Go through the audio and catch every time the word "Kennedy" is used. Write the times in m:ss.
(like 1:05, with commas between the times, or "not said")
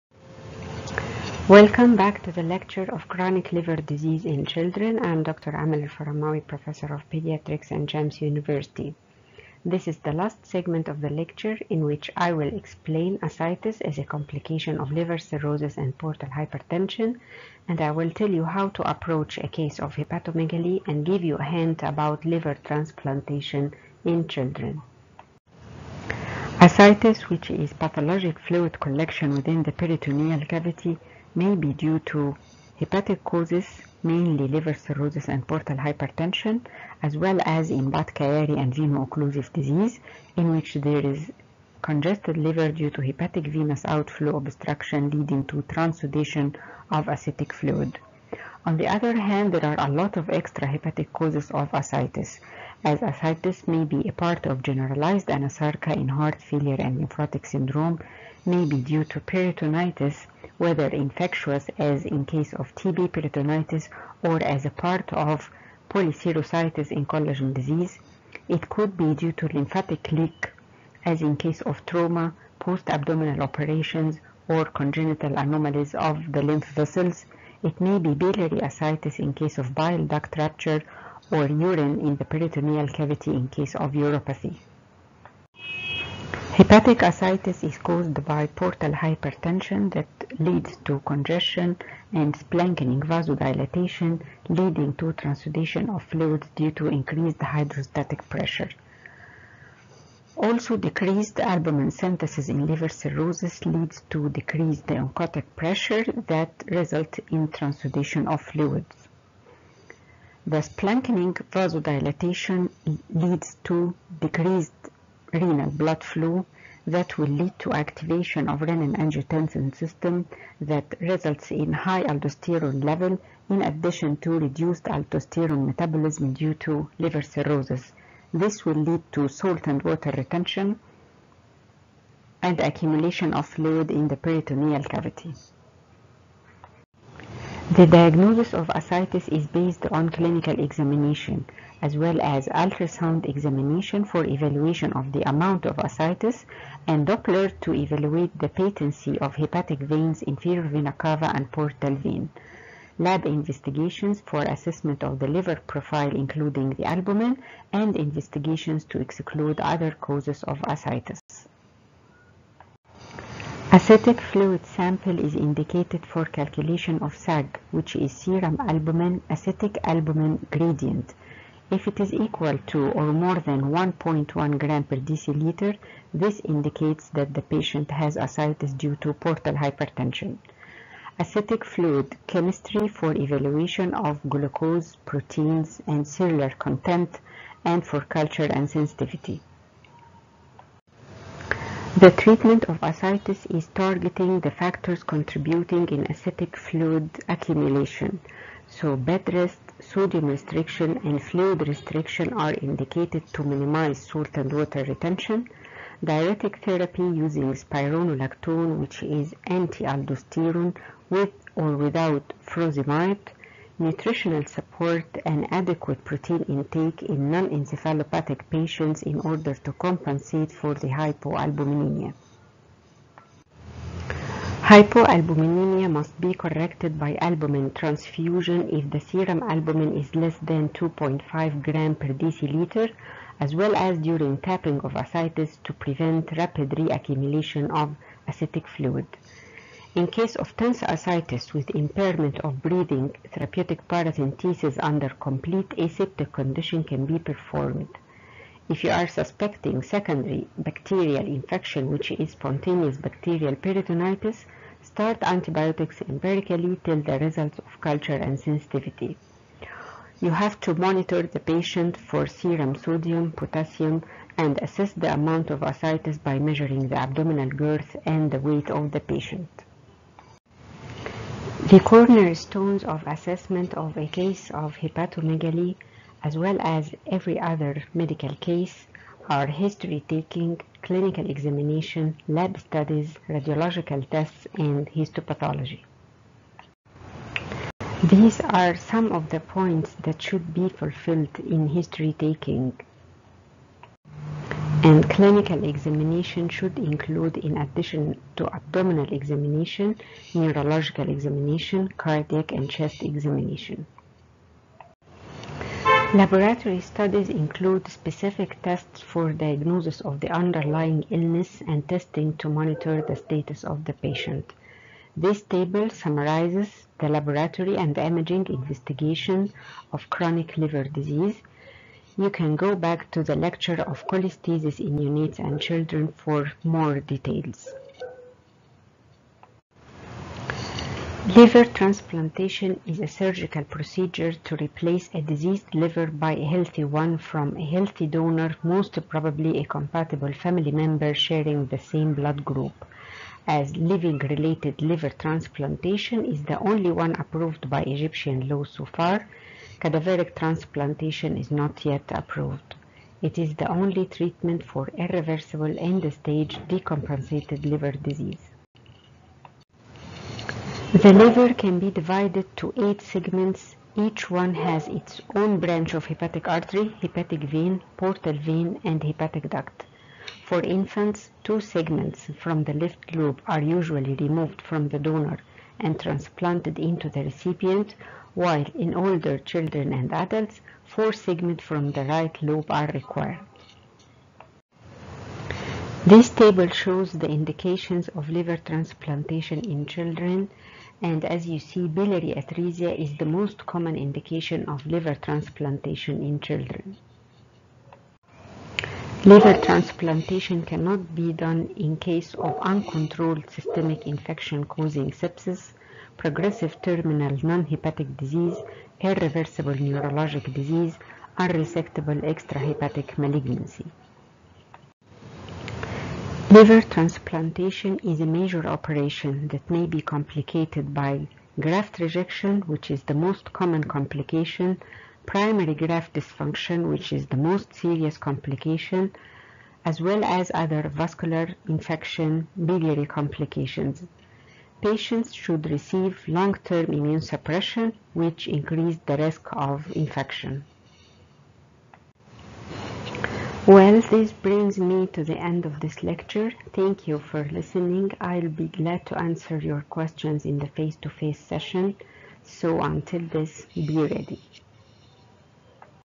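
not said.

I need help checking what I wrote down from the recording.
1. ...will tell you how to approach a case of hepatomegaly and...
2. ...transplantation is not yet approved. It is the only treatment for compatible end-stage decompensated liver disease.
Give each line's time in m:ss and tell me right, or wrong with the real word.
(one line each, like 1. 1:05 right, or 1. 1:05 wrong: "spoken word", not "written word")
1. 0:17 right
2. 5:50 wrong: "irreversible", not "compatible".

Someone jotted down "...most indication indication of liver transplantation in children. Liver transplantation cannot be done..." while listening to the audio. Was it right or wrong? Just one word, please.
wrong.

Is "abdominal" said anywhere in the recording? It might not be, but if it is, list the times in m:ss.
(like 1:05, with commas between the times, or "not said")
1:12, 4:26, 4:58.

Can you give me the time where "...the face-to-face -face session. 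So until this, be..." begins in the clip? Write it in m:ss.
7:30.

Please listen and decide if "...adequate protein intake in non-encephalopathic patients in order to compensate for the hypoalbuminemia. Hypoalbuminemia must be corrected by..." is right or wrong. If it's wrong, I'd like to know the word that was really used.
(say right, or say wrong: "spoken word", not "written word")
right.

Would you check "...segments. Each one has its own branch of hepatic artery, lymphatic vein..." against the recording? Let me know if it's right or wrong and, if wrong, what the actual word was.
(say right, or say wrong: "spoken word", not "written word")
wrong: "hepatic", not "lymphatic".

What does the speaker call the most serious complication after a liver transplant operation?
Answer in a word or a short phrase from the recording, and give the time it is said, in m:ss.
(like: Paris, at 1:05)
Primary graft dysfunction, at 7:05.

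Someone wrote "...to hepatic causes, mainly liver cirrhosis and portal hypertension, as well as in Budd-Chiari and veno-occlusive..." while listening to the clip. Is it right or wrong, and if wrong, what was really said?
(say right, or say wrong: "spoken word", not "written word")
right.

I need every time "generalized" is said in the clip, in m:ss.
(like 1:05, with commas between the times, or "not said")
0:54.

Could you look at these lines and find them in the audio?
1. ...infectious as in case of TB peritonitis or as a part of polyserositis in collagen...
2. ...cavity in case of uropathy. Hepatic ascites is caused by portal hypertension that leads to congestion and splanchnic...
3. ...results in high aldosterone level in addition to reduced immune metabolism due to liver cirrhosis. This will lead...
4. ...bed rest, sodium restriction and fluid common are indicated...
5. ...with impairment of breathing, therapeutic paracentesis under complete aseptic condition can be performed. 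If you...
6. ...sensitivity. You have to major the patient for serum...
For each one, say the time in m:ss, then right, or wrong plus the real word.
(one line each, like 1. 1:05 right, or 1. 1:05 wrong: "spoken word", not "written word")
1. 1:00 right
2. 1:22 right
3. 2:00 wrong: "aldosterone", not "immune"
4. 3:18 wrong: "restriction", not "common"
5. 4:01 right
6. 4:18 wrong: "monitor", not "major".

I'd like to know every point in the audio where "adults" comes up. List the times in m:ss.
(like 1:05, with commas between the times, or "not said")
5:25, 6:20.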